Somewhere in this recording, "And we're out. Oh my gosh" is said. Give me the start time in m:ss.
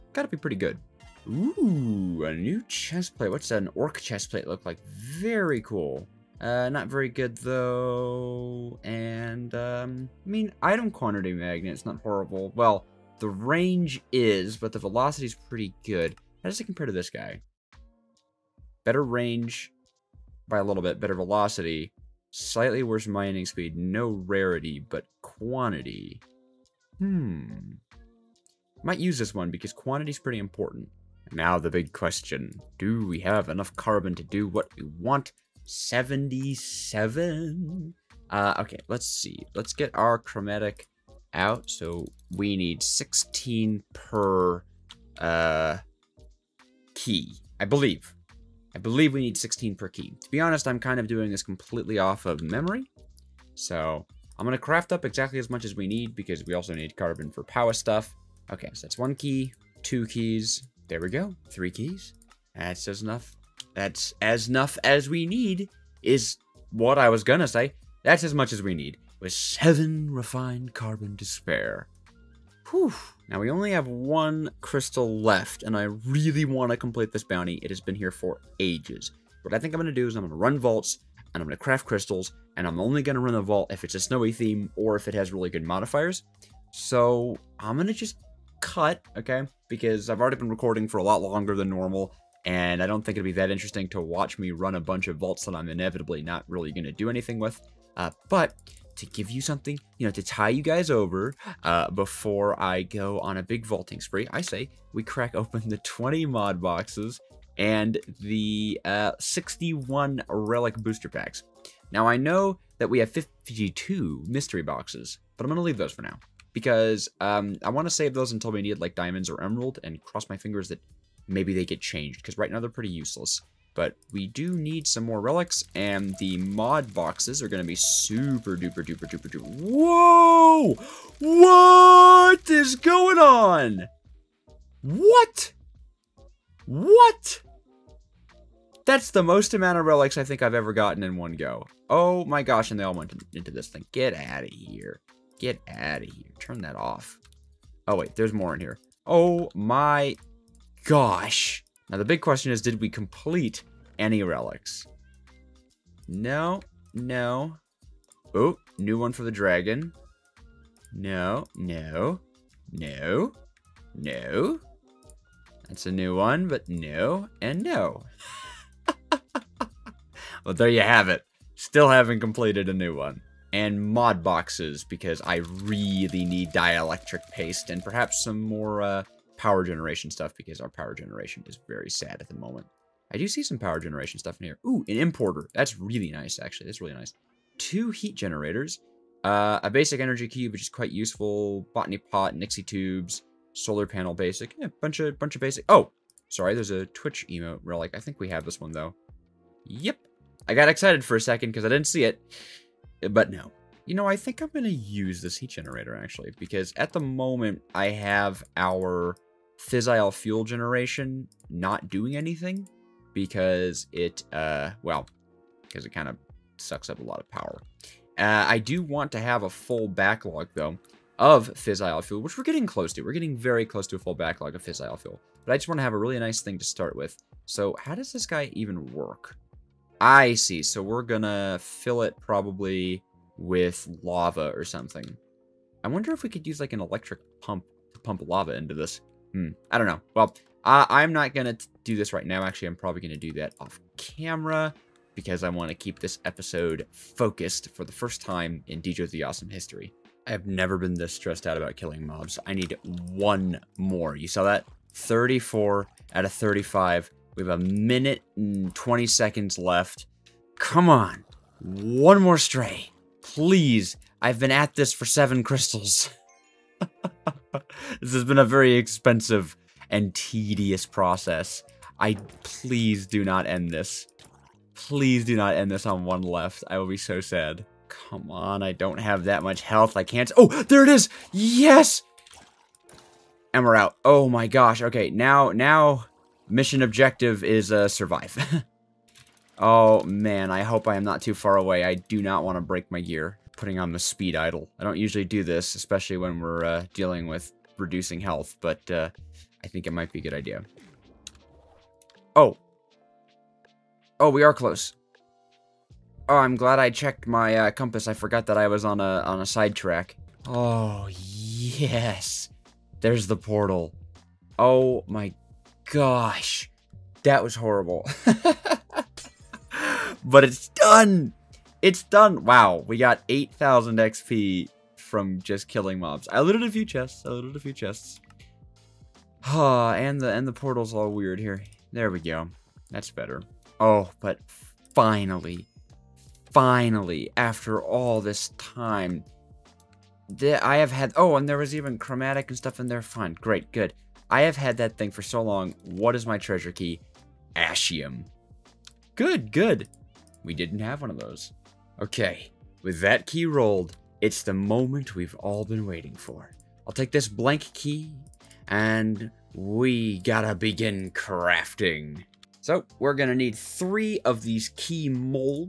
4:43.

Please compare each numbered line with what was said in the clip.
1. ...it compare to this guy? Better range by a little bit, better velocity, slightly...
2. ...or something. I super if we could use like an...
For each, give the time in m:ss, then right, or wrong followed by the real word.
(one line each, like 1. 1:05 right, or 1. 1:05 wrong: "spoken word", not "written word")
1. 0:16 right
2. 3:54 wrong: "wonder", not "super".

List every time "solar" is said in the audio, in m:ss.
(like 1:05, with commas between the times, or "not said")
3:13.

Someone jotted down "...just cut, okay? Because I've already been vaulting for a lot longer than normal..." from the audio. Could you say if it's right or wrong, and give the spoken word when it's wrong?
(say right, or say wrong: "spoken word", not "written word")
wrong: "recording", not "vaulting".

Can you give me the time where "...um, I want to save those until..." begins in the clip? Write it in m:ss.
1:57.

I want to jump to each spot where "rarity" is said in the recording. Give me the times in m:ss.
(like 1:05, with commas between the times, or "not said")
0:24.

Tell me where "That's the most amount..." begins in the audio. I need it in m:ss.
2:18.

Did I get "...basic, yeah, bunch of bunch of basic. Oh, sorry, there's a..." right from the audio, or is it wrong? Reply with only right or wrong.
right.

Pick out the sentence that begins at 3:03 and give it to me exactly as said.
I do see some power generation stuff in here.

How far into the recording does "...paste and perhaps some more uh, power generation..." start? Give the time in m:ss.
2:57.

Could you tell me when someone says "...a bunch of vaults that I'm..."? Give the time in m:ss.
1:34.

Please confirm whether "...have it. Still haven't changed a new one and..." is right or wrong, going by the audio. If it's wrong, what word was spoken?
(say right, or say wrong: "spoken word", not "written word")
wrong: "completed", not "changed".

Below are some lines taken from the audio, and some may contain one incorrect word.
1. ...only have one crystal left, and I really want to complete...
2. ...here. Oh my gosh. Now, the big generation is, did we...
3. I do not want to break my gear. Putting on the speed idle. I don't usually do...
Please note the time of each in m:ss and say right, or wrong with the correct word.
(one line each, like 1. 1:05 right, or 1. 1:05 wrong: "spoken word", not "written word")
1. 1:13 right
2. 2:28 wrong: "question", not "generation"
3. 4:51 right.